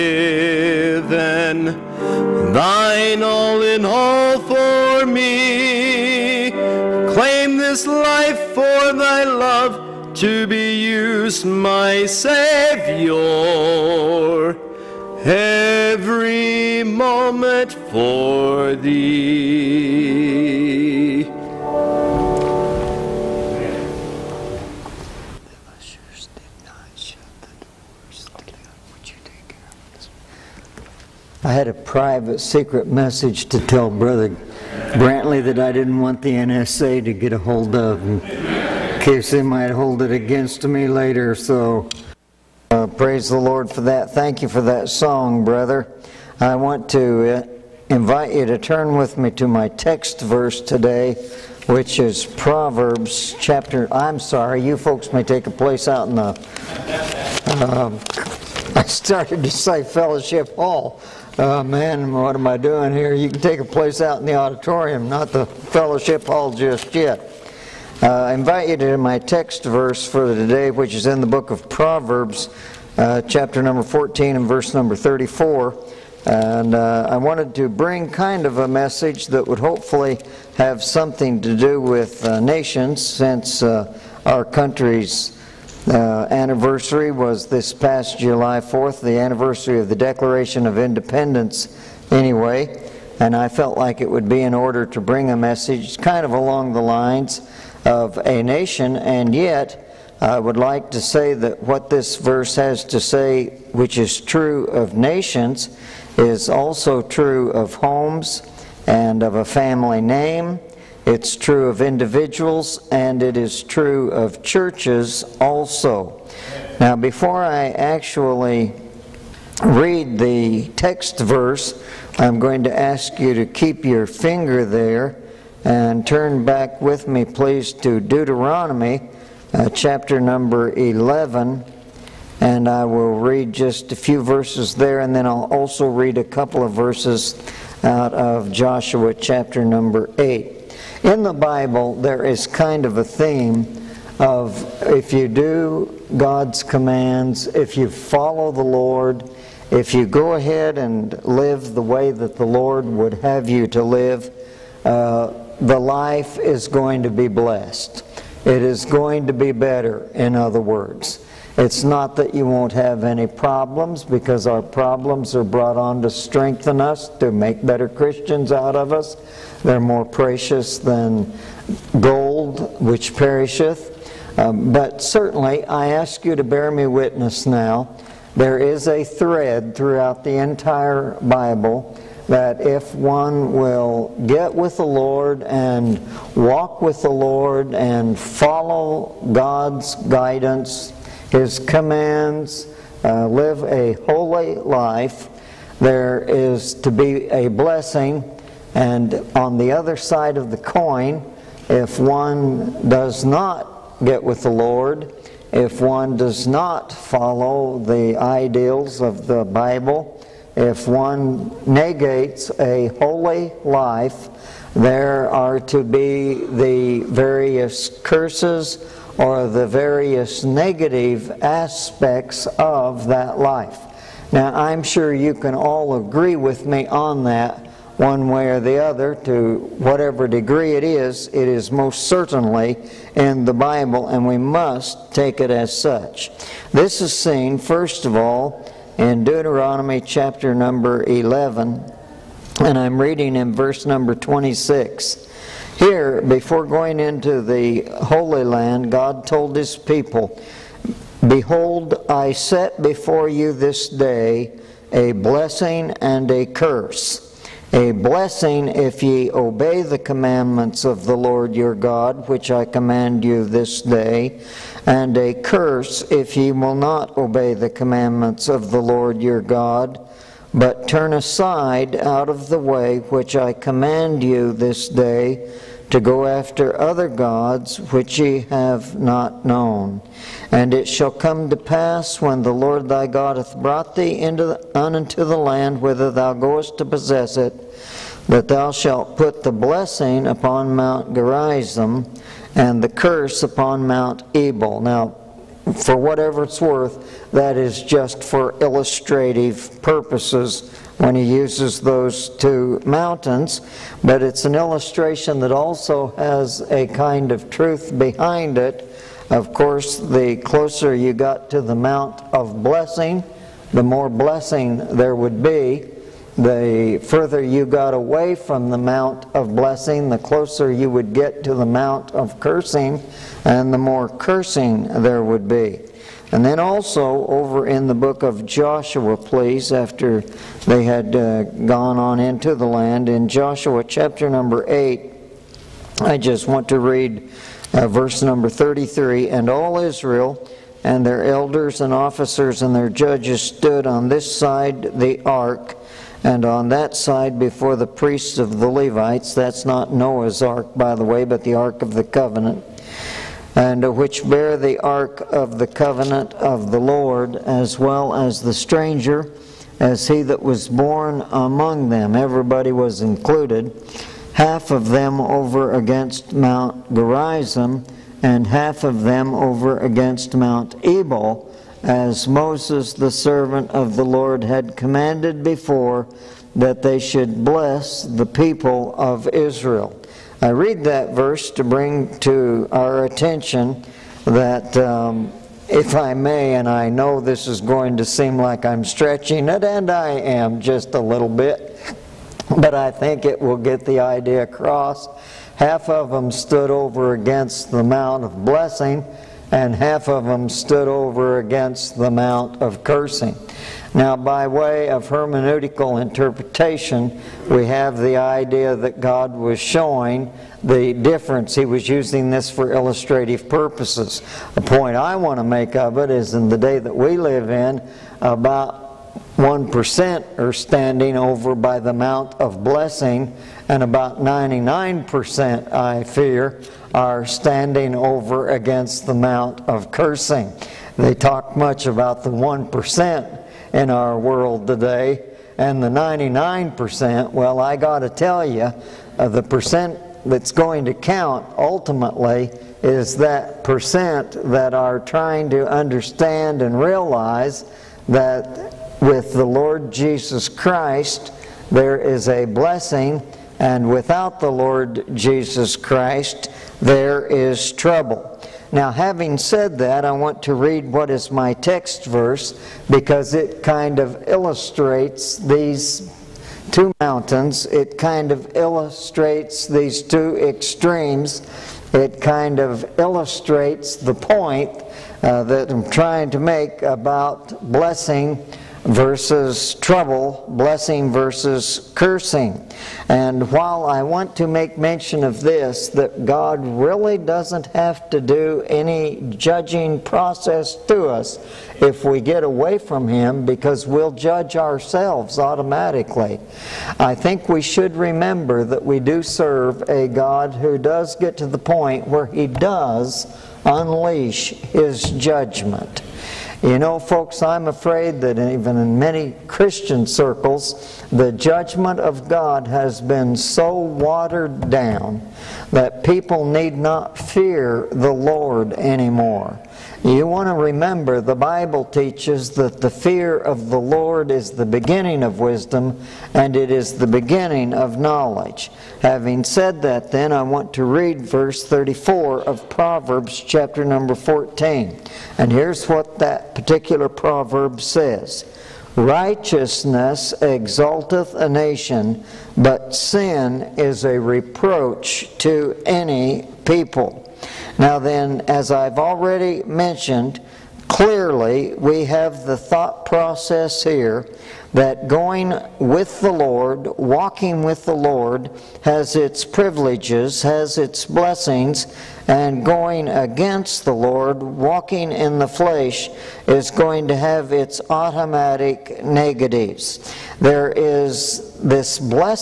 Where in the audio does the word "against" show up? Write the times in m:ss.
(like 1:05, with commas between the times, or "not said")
0:40, 6:05, 6:09, 6:37, 6:41, 7:08, 9:23.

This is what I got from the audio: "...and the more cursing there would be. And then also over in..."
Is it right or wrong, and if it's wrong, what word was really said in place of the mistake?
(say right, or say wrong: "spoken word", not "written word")
right.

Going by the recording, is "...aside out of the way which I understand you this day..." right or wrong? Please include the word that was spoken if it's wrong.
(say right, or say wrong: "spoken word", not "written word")
wrong: "command", not "understand".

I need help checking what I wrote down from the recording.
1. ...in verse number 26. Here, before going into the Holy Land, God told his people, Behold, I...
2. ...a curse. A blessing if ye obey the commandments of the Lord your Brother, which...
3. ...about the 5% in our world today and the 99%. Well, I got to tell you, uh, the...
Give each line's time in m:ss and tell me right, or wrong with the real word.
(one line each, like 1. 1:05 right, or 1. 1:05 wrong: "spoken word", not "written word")
1. 4:03 right
2. 4:16 wrong: "God", not "Brother"
3. 7:11 wrong: "1", not "5".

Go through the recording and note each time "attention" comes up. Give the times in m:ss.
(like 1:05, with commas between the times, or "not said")
6:23.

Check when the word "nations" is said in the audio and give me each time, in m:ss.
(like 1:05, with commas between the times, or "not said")
1:22, 1:38, 1:44, 9:01.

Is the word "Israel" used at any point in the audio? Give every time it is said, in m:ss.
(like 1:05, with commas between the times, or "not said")
5:39, 6:19.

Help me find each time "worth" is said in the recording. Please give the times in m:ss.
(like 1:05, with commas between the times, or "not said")
4:56.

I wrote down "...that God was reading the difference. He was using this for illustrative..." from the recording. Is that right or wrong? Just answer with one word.
wrong.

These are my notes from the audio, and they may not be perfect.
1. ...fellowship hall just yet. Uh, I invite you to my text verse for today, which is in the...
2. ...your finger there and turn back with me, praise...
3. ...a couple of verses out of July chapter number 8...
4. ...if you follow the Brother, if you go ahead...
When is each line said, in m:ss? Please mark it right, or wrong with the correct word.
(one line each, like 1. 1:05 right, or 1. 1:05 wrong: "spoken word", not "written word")
1. 1:05 right
2. 2:03 wrong: "please", not "praise"
3. 2:16 wrong: "Joshua", not "July"
4. 2:27 wrong: "Lord", not "Brother".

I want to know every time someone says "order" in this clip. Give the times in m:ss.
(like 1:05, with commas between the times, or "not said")
1:34.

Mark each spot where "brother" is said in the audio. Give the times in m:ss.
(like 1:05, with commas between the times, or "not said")
0:33, 0:45.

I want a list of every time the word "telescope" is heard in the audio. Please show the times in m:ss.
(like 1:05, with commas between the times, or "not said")
not said.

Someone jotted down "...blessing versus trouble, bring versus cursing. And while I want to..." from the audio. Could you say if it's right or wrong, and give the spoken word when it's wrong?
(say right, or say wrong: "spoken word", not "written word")
wrong: "blessing", not "bring".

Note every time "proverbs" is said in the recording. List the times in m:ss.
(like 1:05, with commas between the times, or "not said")
0:52, 1:11, 8:52, 8:57.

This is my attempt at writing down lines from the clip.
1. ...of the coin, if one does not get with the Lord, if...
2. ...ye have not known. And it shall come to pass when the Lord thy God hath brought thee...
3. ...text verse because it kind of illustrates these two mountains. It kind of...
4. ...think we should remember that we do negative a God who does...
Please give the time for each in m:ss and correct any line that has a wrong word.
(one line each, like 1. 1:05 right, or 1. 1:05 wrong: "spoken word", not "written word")
1. 3:20 right
2. 4:38 right
3. 7:41 right
4. 8:17 wrong: "serve", not "negative".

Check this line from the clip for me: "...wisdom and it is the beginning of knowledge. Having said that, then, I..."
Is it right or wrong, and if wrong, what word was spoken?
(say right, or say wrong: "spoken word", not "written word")
right.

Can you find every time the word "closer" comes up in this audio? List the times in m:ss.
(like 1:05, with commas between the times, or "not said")
5:10, 5:20.